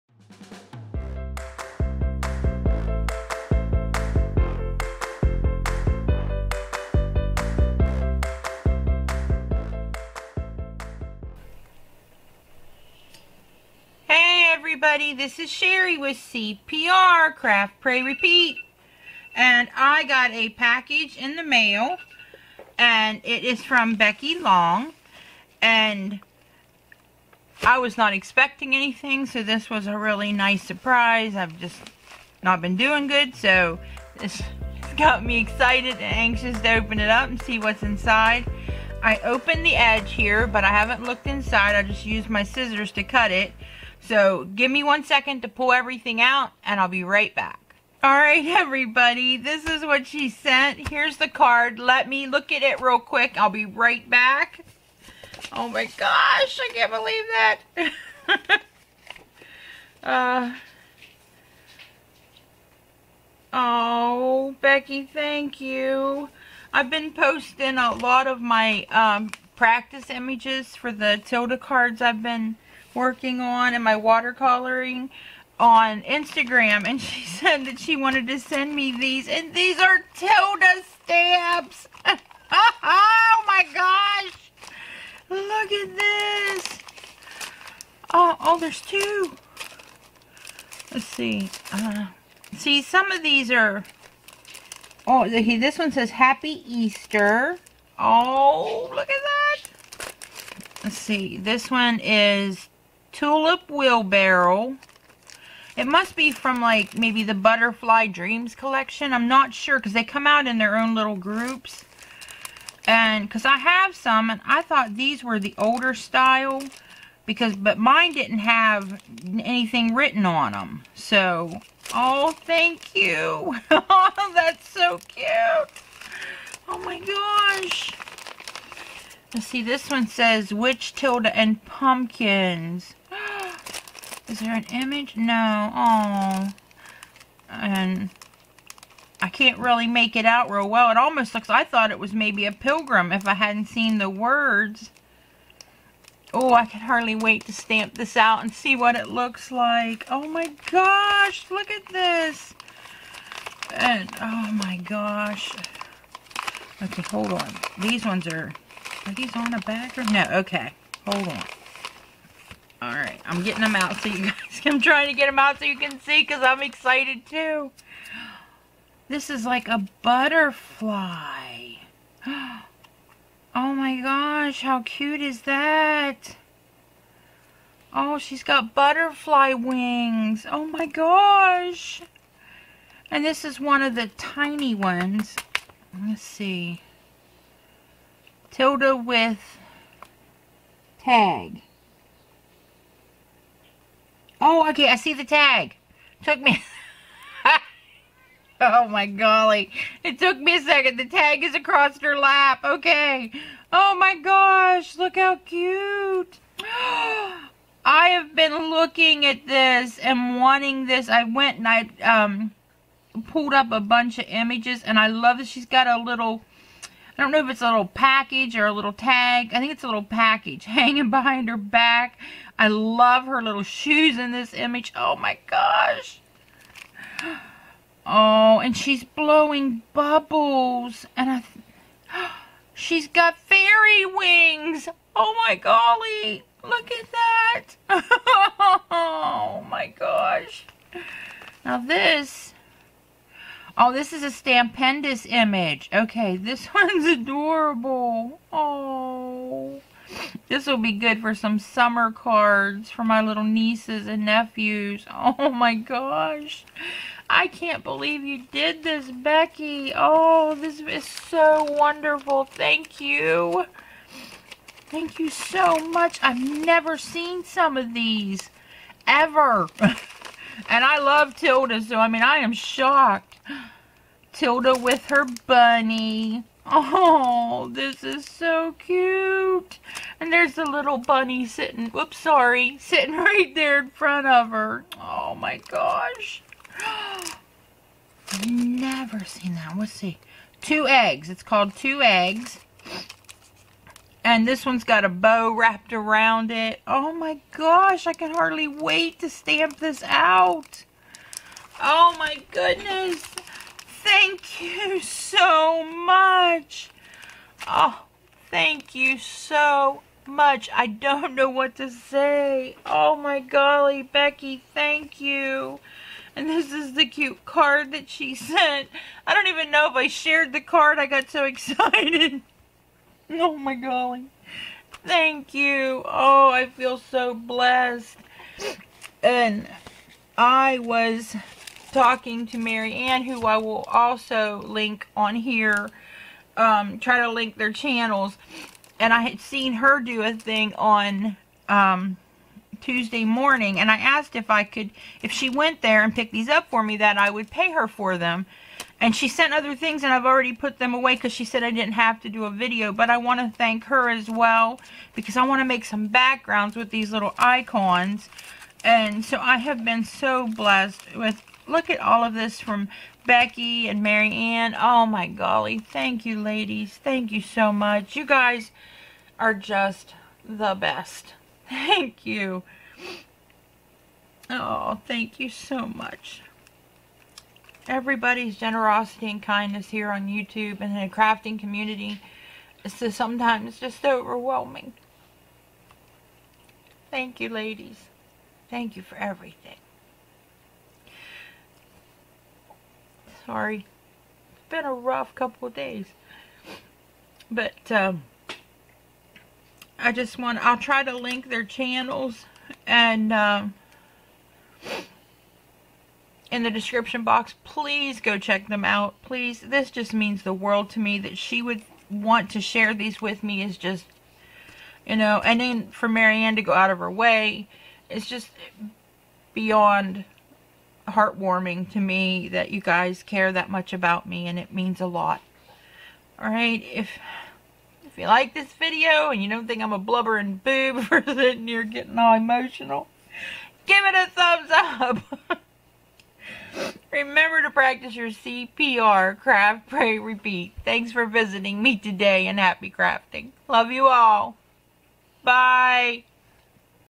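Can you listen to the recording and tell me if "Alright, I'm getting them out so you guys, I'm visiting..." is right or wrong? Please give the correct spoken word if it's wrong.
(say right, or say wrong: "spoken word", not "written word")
wrong: "trying", not "visiting".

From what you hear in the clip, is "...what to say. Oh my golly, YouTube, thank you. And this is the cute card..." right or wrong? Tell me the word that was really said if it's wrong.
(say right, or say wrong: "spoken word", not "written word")
wrong: "Becky", not "YouTube".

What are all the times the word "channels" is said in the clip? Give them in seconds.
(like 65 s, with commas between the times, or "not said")
337 s, 401 s.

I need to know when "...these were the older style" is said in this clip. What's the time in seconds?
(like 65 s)
114 s.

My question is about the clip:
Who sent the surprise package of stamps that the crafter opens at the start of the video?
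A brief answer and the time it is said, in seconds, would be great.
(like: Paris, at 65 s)
Becky Long, at 23 s.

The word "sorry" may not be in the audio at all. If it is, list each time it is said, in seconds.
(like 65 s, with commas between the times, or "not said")
282 s, 393 s.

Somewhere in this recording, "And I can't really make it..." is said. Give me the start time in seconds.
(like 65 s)
137 s.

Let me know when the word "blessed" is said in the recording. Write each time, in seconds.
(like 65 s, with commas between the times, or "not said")
327 s, 360 s.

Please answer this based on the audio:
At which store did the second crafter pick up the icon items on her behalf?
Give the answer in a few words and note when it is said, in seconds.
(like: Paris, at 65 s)
Tuesday Morning, at 342 s.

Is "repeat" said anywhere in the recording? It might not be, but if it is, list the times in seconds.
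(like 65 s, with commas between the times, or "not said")
18 s, 440 s.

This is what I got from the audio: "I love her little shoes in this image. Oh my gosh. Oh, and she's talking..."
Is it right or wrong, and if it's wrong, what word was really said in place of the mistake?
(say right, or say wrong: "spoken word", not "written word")
wrong: "blowing", not "talking".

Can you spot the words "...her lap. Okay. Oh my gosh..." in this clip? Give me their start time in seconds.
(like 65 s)
202 s.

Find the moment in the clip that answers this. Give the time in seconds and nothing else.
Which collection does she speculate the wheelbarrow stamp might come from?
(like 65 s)
107 s.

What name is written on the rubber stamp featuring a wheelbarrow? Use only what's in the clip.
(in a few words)
Tulip Wheelbarrow.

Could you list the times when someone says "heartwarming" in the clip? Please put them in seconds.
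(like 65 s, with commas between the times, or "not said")
421 s.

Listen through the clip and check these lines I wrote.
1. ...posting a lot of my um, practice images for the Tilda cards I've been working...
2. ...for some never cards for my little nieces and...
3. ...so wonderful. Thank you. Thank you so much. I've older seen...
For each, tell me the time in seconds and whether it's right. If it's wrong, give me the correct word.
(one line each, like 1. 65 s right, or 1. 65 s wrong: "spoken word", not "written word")
1. 67 s right
2. 251 s wrong: "summer", not "never"
3. 261 s wrong: "never", not "older".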